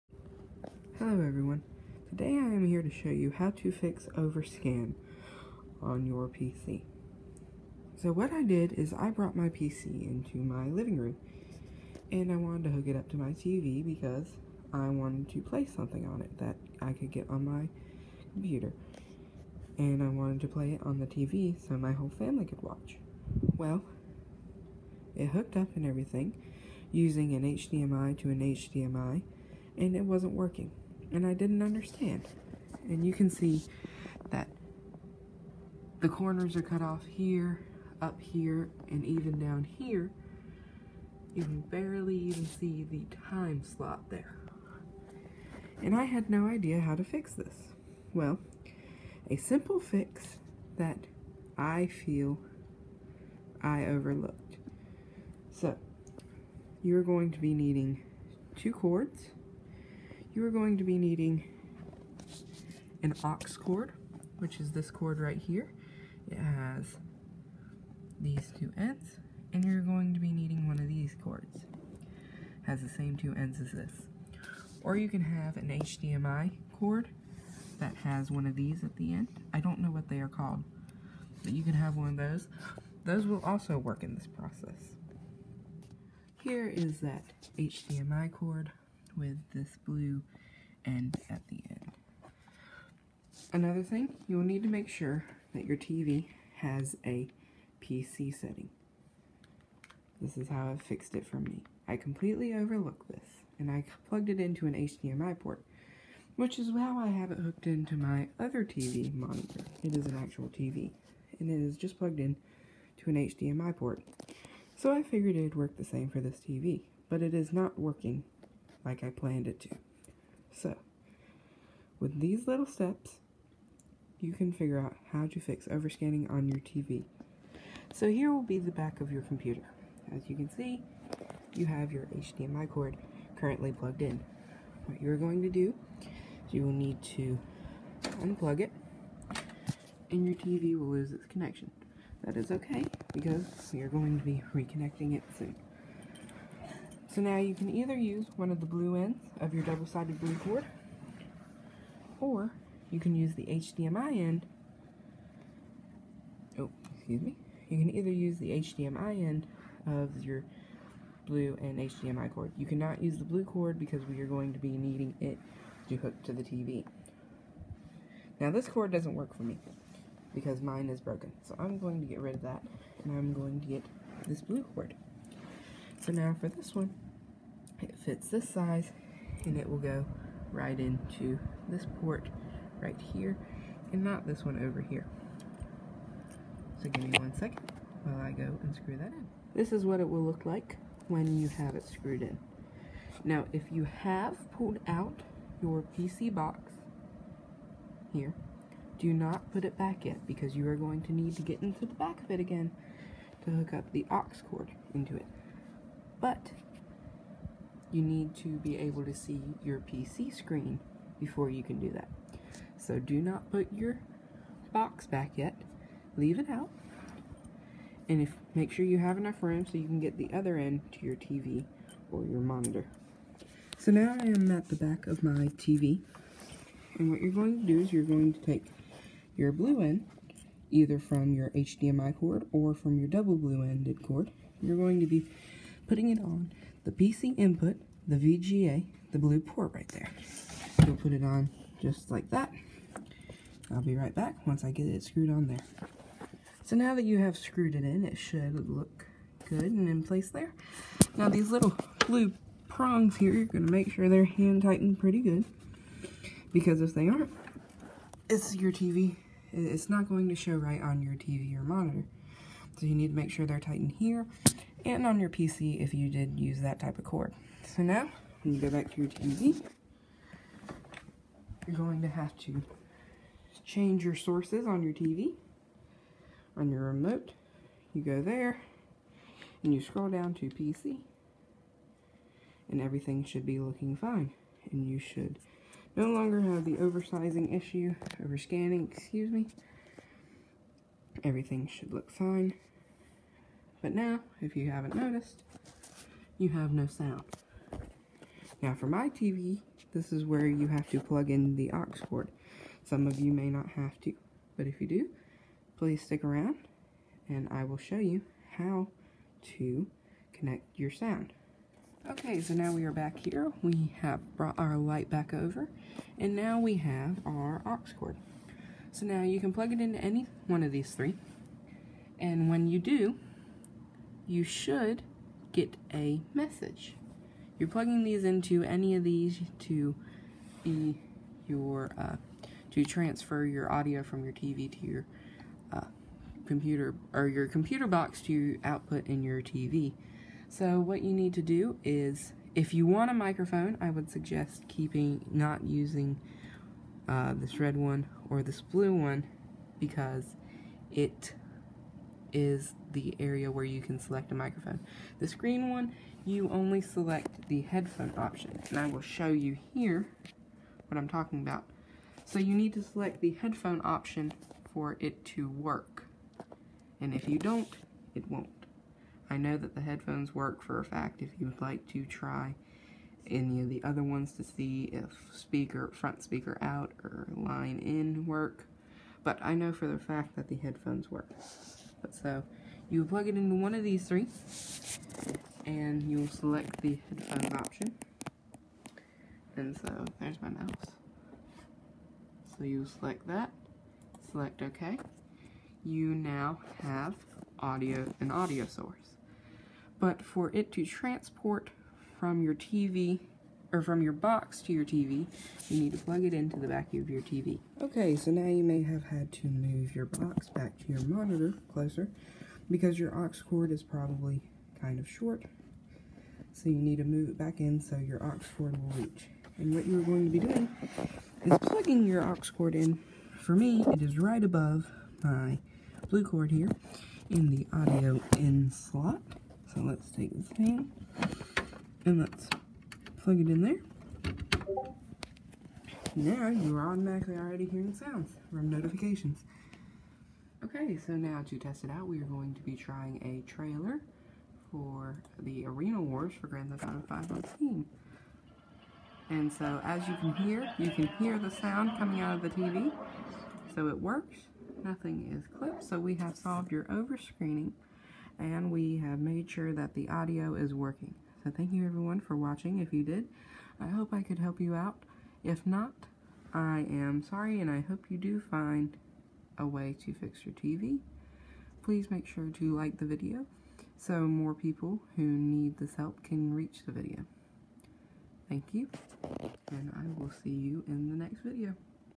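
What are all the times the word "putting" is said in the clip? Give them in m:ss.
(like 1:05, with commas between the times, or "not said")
3:55.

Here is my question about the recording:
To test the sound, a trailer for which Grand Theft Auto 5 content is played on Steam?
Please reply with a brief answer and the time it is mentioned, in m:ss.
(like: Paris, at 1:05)
Arena Wars, at 7:25.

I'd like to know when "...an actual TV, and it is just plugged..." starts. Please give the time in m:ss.
1:50.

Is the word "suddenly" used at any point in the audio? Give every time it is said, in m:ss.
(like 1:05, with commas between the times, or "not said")
not said.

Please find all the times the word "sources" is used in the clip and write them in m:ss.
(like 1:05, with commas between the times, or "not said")
4:34, 6:38.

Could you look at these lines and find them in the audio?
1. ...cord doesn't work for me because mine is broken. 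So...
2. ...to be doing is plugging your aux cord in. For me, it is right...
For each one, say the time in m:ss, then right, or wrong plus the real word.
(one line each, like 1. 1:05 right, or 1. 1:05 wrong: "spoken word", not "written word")
1. 2:48 right
2. 7:00 right.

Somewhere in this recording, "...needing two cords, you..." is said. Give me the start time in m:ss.
0:57.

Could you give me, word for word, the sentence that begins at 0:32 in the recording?
And you can see that the corners are cut off here, up here, and even down here.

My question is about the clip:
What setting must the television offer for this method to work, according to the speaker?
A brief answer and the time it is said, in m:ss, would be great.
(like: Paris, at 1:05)
PC setting, at 1:37.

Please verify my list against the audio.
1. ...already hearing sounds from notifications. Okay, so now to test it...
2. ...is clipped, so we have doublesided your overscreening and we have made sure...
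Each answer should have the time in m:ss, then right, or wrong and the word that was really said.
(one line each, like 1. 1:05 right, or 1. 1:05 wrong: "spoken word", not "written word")
1. 7:17 right
2. 7:35 wrong: "solved", not "doublesided".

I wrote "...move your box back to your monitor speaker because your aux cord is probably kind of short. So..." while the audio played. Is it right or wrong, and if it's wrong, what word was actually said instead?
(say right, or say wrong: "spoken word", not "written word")
wrong: "closer", not "speaker".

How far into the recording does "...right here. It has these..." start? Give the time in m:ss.
1:05.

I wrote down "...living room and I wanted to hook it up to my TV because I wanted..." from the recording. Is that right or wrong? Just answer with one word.
right.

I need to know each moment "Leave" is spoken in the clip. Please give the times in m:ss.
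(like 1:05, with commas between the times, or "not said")
3:36.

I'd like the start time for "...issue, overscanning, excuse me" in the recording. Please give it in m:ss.
4:47.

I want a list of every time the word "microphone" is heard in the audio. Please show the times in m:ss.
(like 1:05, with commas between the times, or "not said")
5:43, 5:54.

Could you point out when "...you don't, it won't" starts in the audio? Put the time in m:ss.
6:07.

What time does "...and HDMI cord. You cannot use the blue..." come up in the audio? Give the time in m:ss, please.
2:41.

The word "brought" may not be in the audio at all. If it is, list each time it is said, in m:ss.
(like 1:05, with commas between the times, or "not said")
0:09, 5:14.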